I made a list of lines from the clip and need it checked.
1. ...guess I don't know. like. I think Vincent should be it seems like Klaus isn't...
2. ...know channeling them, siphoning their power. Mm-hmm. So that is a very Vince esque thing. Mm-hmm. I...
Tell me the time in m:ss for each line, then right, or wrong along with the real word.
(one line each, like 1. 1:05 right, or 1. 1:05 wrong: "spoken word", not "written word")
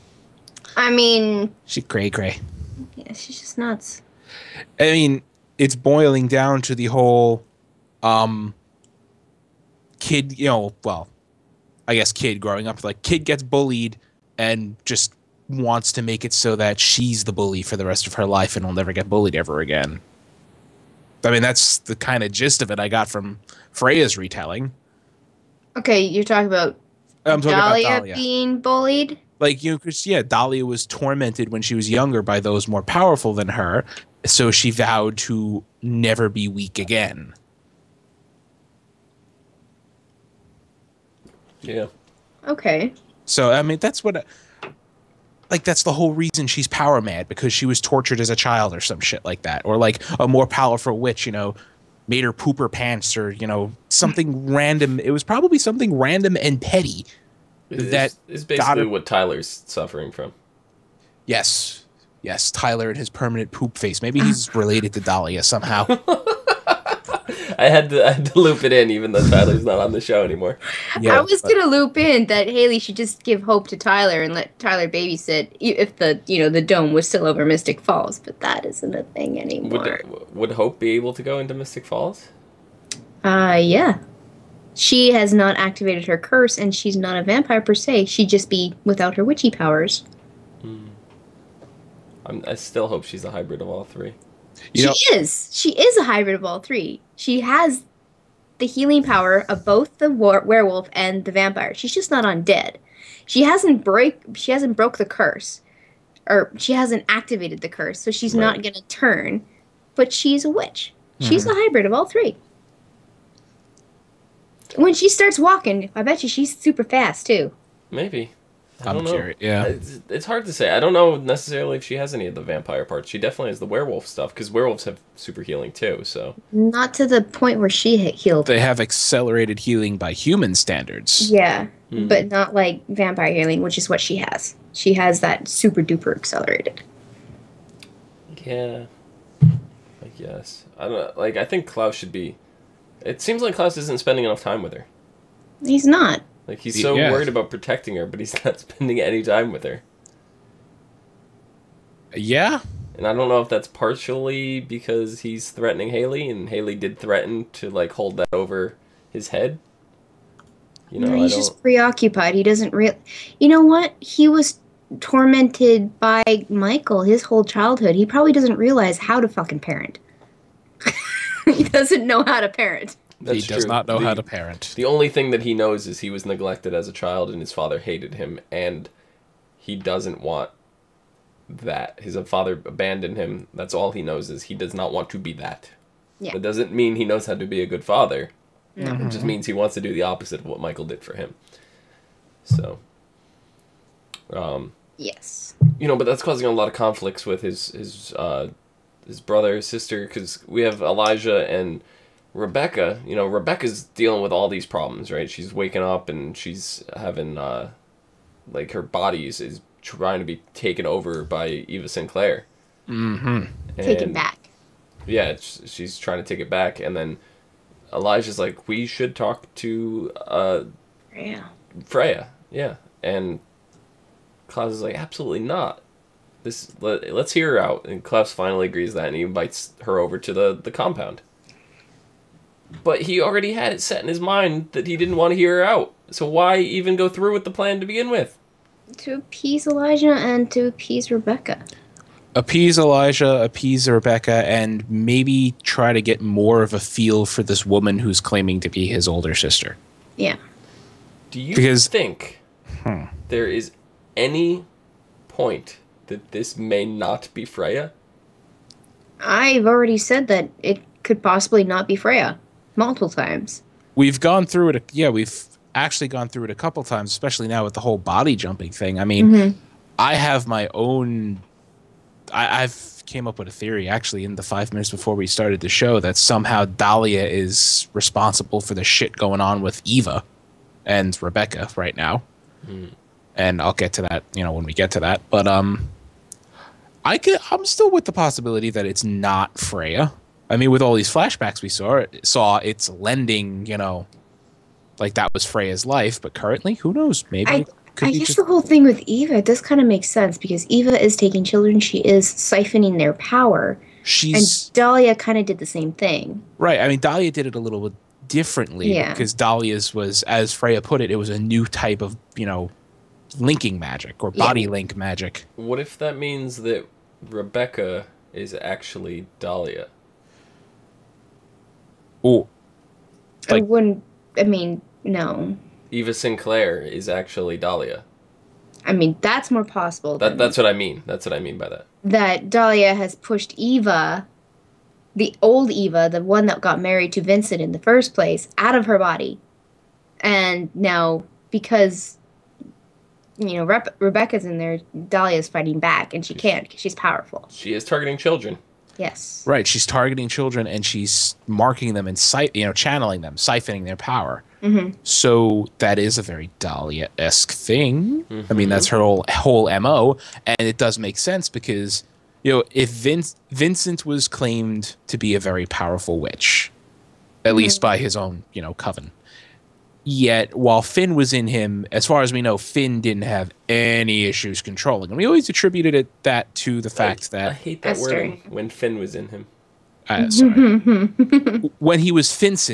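1. 2:20 wrong: "Klaus", not "Vincent"
2. 5:52 wrong: "Dahlia", not "Vince".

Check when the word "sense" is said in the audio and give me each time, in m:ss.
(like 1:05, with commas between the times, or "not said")
5:00, 6:01.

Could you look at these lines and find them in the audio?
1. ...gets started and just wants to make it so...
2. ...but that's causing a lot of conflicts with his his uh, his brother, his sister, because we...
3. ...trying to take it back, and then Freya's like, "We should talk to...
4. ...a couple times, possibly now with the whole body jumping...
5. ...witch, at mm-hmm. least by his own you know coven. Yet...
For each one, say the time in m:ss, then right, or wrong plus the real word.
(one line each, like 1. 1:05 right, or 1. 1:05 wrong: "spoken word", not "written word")
1. 0:13 wrong: "bullied", not "started"
2. 3:15 right
3. 3:35 wrong: "Elijah", not "Freya"
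4. 4:26 wrong: "especially", not "possibly"
5. 6:06 right.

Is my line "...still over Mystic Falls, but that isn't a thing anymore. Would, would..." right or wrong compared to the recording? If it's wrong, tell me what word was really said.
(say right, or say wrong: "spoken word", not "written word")
right.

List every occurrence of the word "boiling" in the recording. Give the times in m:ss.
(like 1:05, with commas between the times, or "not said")
0:05.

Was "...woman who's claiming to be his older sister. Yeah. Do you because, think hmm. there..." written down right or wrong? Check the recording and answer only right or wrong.
right.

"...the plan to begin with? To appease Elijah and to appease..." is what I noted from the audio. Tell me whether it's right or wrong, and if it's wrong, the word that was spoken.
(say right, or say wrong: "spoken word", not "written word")
right.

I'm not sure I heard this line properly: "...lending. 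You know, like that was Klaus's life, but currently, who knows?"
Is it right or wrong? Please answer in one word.
wrong.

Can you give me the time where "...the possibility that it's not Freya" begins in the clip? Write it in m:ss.
4:48.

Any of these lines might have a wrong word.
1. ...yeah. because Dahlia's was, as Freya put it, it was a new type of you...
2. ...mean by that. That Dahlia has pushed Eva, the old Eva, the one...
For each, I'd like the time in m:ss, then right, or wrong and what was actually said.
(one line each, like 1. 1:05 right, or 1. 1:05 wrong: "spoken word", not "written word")
1. 5:08 right
2. 5:31 right.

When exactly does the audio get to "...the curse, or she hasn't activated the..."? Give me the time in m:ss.
1:44.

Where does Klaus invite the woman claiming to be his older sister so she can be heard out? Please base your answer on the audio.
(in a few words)
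the compound.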